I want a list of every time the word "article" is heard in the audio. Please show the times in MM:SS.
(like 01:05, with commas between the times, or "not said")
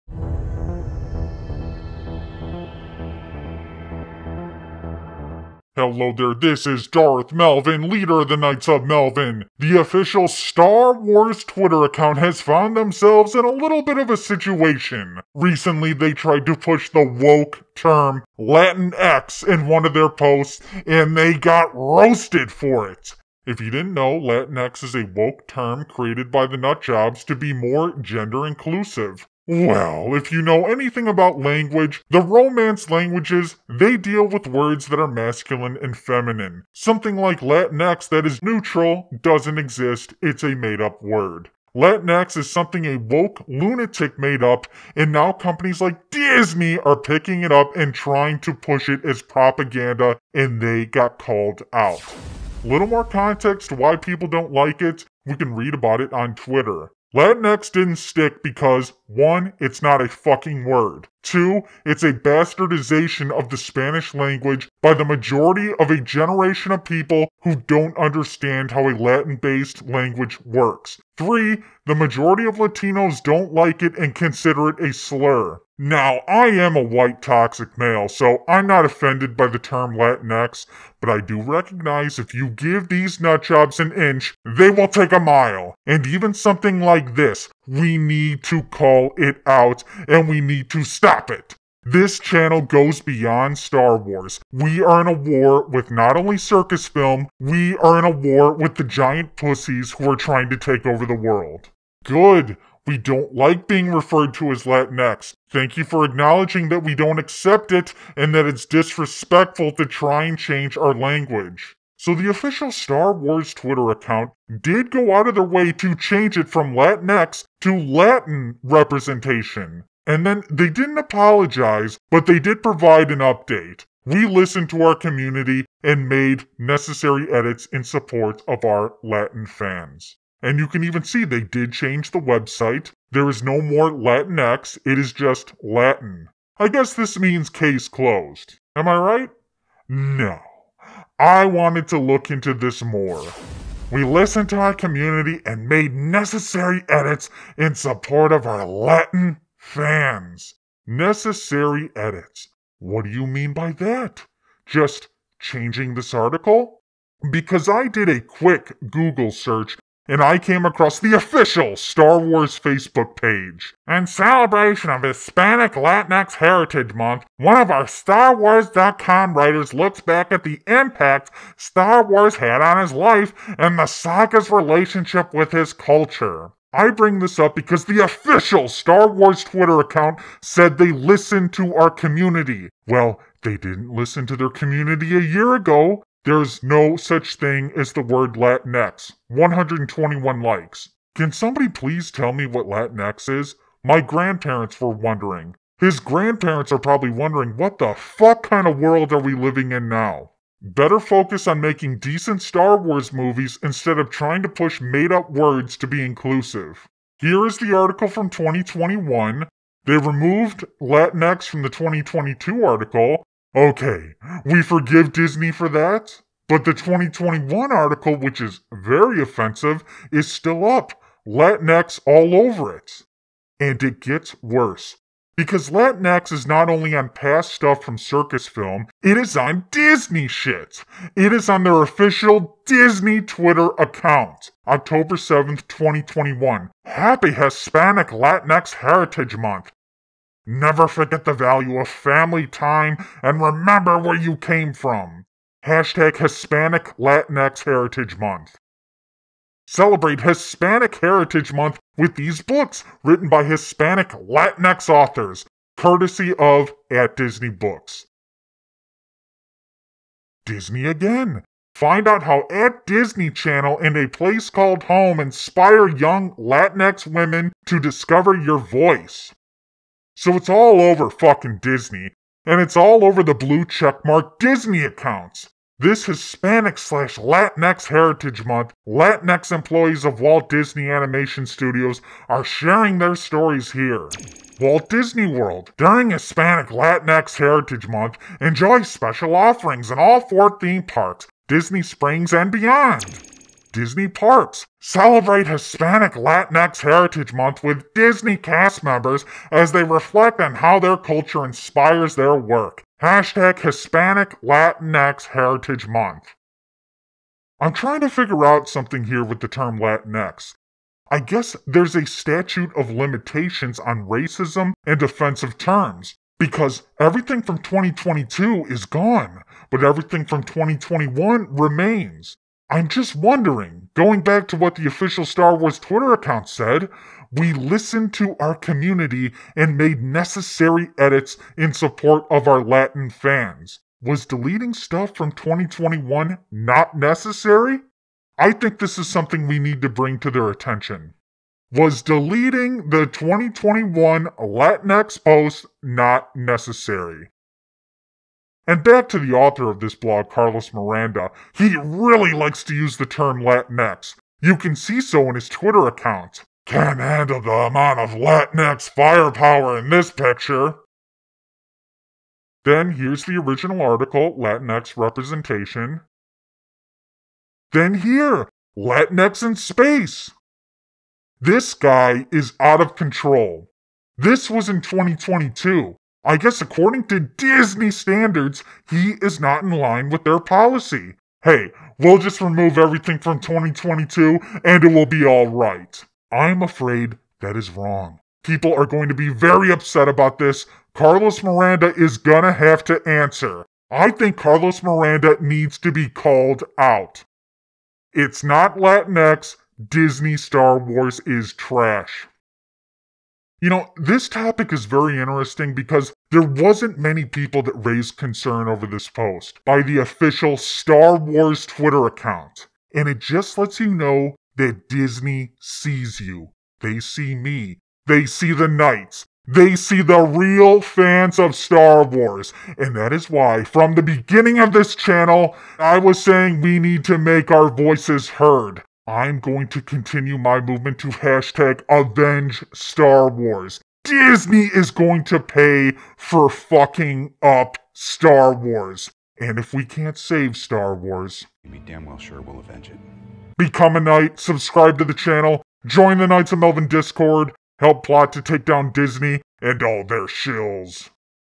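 02:36, 03:27, 03:32, 03:37, 06:03.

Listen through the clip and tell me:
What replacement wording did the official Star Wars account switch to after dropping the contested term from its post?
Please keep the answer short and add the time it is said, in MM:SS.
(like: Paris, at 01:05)
Latin representation, at 01:57.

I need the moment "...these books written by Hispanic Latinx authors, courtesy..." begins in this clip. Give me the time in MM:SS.
04:12.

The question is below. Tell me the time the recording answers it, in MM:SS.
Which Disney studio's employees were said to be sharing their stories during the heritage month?
04:40.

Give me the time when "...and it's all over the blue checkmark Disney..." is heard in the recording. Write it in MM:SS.
04:32.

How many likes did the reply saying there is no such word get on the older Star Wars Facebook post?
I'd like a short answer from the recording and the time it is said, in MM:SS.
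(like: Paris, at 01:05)
121, at 03:09.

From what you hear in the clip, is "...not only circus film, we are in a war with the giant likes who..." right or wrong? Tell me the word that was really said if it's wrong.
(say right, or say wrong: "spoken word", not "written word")
wrong: "pussies", not "likes".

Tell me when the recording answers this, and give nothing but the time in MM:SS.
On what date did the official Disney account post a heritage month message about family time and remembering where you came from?
03:54.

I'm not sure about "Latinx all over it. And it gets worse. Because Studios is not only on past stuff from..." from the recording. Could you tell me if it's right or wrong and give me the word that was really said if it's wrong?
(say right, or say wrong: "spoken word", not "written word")
wrong: "Latinx", not "Studios".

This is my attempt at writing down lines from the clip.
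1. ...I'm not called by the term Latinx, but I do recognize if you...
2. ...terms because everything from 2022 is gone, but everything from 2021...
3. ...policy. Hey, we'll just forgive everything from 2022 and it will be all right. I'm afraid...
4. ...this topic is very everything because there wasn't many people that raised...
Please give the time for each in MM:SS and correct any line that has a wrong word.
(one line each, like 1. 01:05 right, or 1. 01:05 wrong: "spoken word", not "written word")
1. 01:18 wrong: "offended", not "called"
2. 05:15 right
3. 06:20 wrong: "remove", not "forgive"
4. 06:43 wrong: "interesting", not "everything".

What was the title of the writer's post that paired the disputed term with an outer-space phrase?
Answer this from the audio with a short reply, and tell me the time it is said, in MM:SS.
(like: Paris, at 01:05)
Latinx in space, at 06:08.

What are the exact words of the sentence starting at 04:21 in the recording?
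Find out how At Disney Channel and a place called home inspire young Latinx women to discover your voice.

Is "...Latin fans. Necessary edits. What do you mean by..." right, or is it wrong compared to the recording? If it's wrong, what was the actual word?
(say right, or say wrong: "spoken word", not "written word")
right.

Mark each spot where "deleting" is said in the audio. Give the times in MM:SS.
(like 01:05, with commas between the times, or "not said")
05:34, 05:42.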